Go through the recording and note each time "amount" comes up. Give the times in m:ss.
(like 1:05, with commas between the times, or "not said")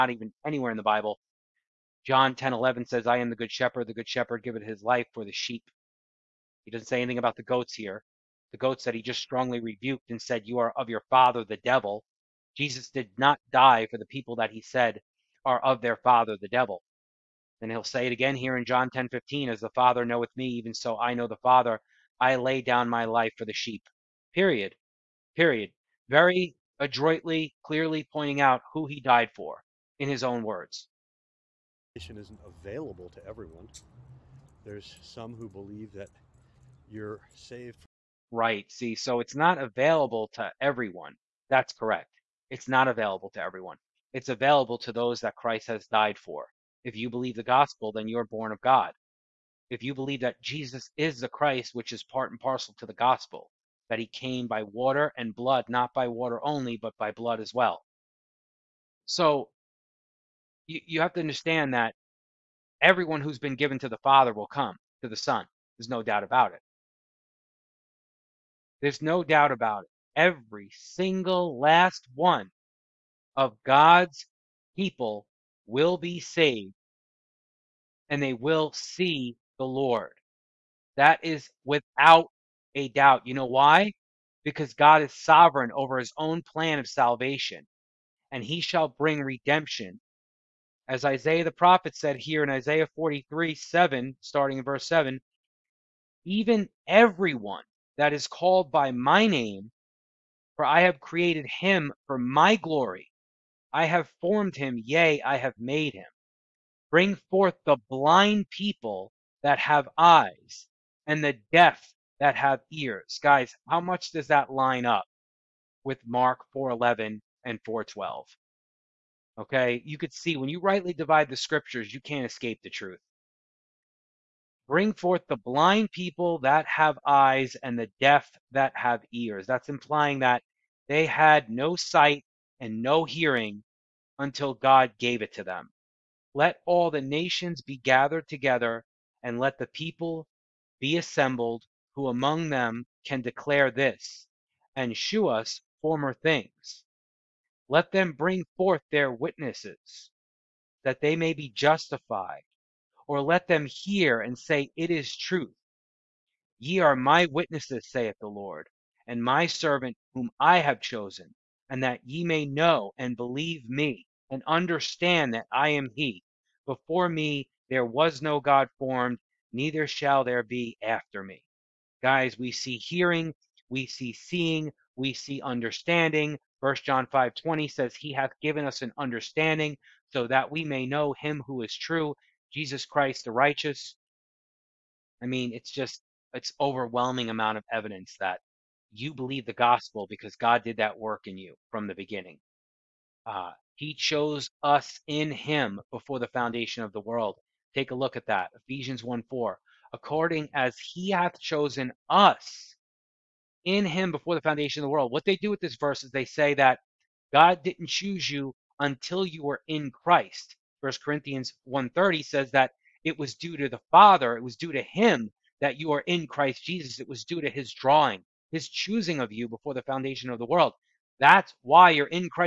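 3:07.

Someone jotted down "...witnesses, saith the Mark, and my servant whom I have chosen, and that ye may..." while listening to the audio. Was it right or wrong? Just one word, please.
wrong.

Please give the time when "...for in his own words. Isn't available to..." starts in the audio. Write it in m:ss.
0:29.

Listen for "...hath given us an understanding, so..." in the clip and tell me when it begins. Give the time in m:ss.
2:58.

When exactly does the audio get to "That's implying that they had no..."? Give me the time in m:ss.
2:09.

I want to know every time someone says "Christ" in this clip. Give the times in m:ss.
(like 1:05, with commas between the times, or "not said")
0:45, 0:51, 3:02, 3:29, 3:36.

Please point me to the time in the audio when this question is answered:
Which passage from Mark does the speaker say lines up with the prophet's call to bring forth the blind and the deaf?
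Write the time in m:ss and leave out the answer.
1:56.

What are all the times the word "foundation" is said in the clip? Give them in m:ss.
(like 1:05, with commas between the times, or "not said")
3:16, 3:24, 3:39.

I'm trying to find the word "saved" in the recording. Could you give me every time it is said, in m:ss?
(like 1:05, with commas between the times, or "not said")
0:37, 1:16.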